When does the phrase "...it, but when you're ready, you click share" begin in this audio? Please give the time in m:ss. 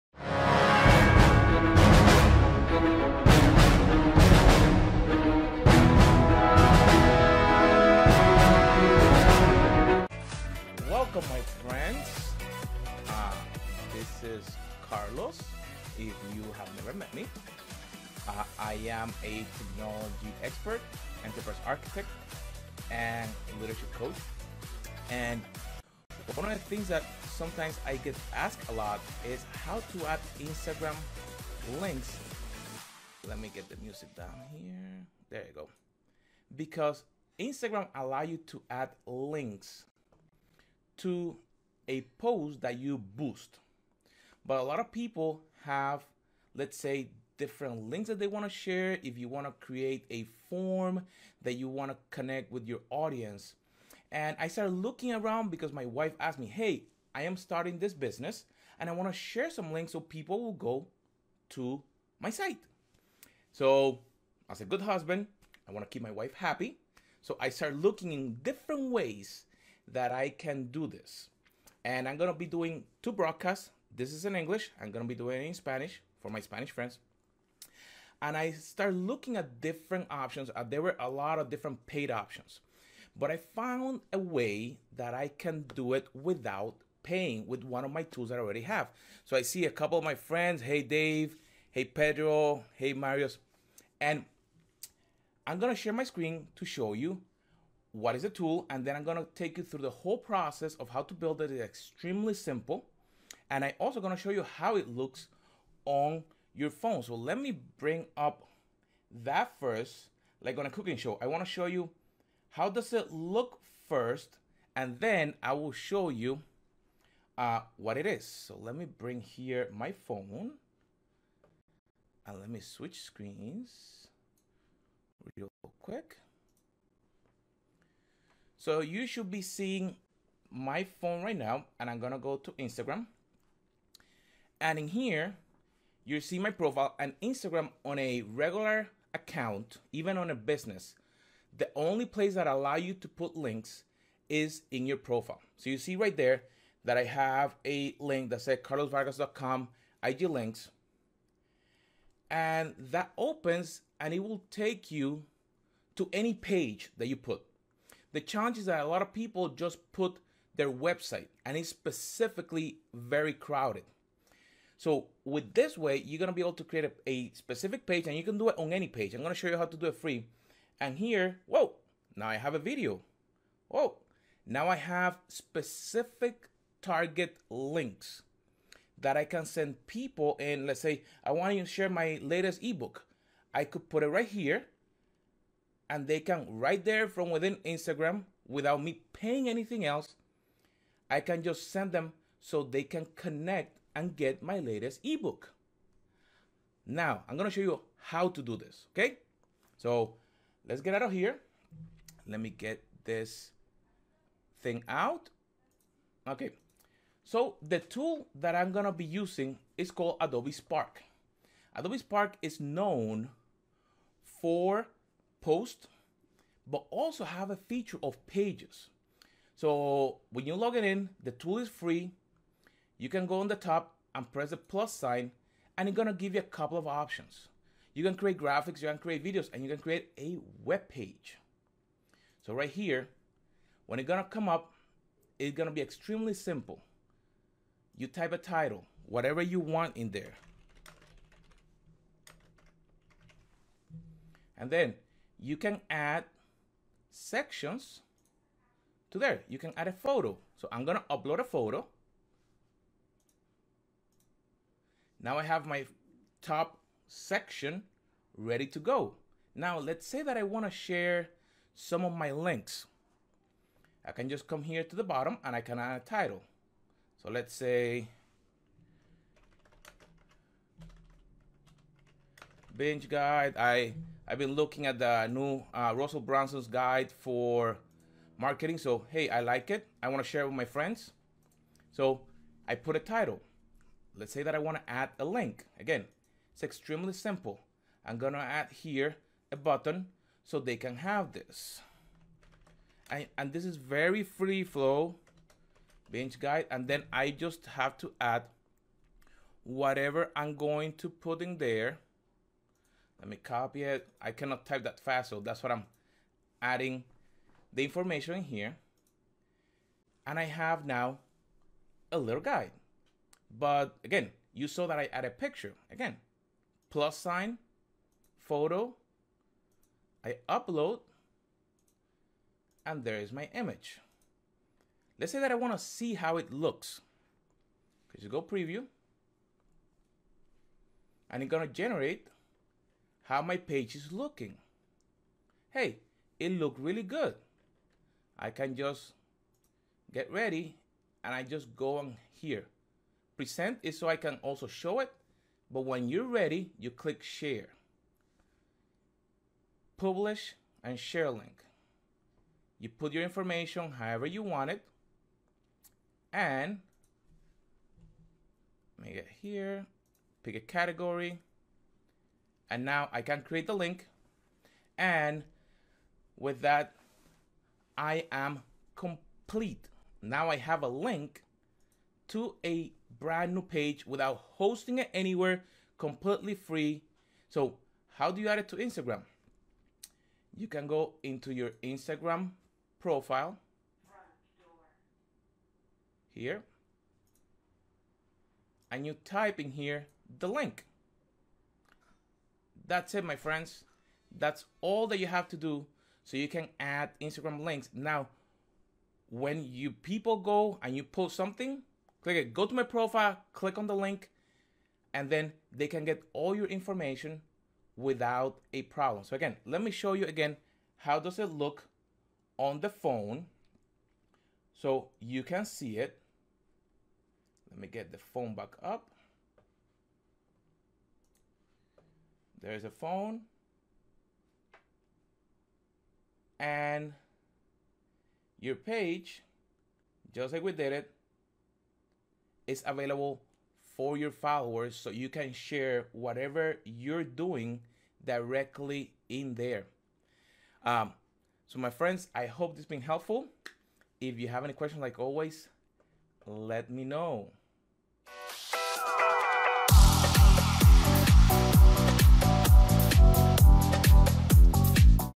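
5:44.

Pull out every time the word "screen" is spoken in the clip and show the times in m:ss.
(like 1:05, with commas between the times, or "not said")
1:36, 2:03.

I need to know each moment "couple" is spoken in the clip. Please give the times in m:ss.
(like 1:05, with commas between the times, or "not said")
1:29, 3:46.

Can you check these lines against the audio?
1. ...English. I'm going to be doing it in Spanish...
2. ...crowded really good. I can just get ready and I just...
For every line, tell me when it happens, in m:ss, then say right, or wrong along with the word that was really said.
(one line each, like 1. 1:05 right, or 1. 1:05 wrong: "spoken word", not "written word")
1. 1:14 right
2. 5:36 wrong: "looked", not "crowded".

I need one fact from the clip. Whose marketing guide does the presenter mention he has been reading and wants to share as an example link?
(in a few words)
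Russell Brunson.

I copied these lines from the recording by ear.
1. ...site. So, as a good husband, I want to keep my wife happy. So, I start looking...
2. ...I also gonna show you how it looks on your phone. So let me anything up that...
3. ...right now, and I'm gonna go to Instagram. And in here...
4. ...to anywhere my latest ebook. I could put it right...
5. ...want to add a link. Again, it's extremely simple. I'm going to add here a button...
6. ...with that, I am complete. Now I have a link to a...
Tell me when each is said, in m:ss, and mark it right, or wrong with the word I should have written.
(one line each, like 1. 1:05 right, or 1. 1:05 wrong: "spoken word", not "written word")
1. 1:02 right
2. 1:43 wrong: "bring", not "anything"
3. 2:11 right
4. 3:01 wrong: "share", not "anywhere"
5. 4:44 right
6. 6:06 right.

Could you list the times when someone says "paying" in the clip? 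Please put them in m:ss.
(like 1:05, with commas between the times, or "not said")
1:27, 3:09.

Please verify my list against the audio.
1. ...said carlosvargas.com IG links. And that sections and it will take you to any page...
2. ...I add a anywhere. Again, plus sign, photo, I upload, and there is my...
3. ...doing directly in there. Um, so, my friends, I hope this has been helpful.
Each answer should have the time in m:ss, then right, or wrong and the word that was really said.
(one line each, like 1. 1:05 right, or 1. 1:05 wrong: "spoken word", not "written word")
1. 2:28 wrong: "opens", not "sections"
2. 5:14 wrong: "picture", not "anywhere"
3. 7:17 right.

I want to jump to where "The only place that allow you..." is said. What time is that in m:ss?
2:21.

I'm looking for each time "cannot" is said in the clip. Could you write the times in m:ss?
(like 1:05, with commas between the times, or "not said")
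5:04.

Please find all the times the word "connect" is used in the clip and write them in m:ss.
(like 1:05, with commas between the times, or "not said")
0:52, 3:13.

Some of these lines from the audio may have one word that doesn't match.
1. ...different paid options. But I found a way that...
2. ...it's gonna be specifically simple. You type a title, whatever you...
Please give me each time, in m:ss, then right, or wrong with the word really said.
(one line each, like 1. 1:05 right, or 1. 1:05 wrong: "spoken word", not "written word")
1. 1:21 right
2. 3:55 wrong: "extremely", not "specifically".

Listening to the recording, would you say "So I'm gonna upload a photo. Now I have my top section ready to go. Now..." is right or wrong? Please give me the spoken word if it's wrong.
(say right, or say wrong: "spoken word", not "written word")
right.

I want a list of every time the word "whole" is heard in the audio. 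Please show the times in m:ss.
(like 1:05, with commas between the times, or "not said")
1:39.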